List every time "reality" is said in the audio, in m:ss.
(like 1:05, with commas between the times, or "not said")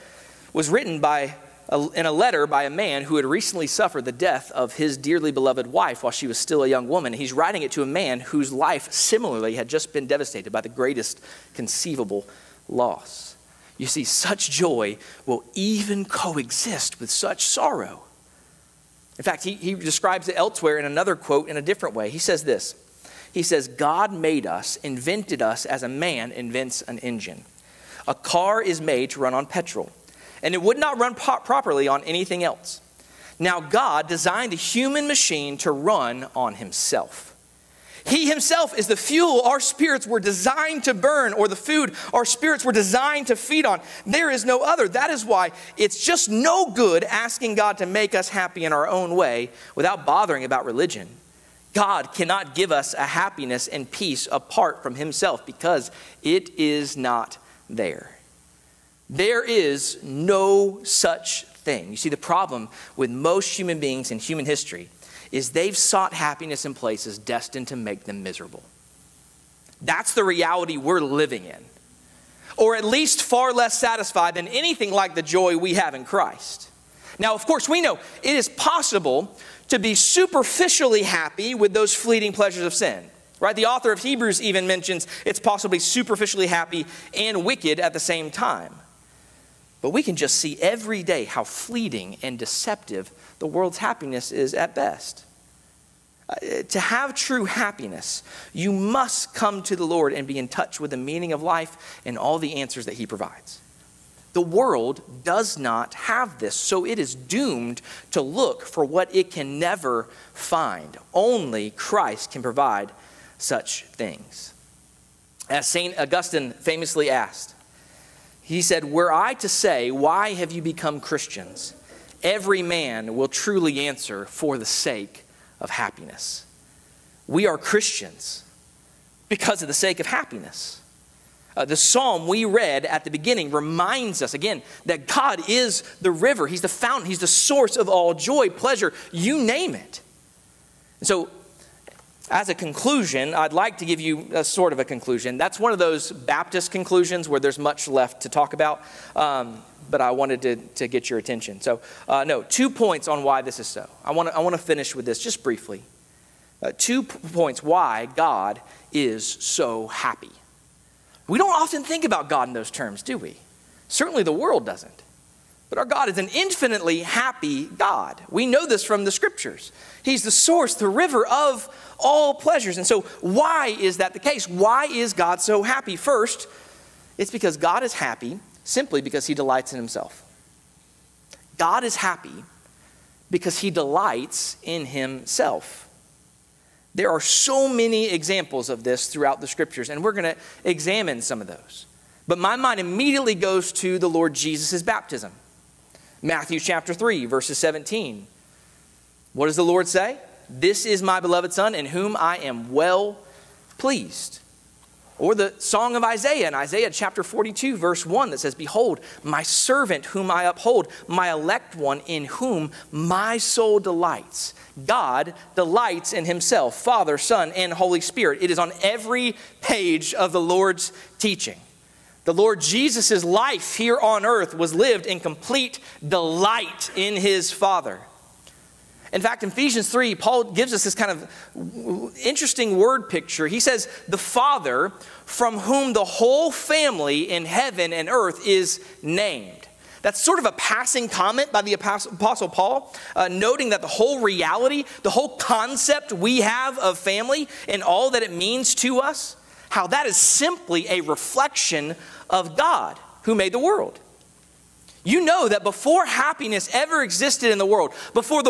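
1:10, 4:04.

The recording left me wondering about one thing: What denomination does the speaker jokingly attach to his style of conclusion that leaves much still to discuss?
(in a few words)
Baptist.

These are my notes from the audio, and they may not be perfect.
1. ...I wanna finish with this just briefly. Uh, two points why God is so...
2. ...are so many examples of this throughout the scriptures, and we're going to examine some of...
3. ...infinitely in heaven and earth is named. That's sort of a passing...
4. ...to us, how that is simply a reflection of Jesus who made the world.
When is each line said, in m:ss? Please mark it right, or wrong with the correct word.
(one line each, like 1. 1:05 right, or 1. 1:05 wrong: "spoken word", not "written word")
1. 2:34 right
2. 3:07 right
3. 3:56 wrong: "family", not "infinitely"
4. 4:08 wrong: "God", not "Jesus".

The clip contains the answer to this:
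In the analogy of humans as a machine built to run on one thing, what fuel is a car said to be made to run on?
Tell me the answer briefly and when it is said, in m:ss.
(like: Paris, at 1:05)
petrol, at 0:29.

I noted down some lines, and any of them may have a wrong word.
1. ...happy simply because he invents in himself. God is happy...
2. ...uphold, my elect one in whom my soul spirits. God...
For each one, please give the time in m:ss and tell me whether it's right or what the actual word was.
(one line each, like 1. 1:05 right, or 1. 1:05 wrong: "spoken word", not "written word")
1. 2:57 wrong: "delights", not "invents"
2. 3:30 wrong: "delights", not "spirits".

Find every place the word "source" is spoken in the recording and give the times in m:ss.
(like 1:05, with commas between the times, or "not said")
2:17, 2:50.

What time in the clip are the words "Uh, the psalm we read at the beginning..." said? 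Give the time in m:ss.
2:11.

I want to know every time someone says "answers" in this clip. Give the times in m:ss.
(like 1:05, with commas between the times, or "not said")
1:42, 2:03.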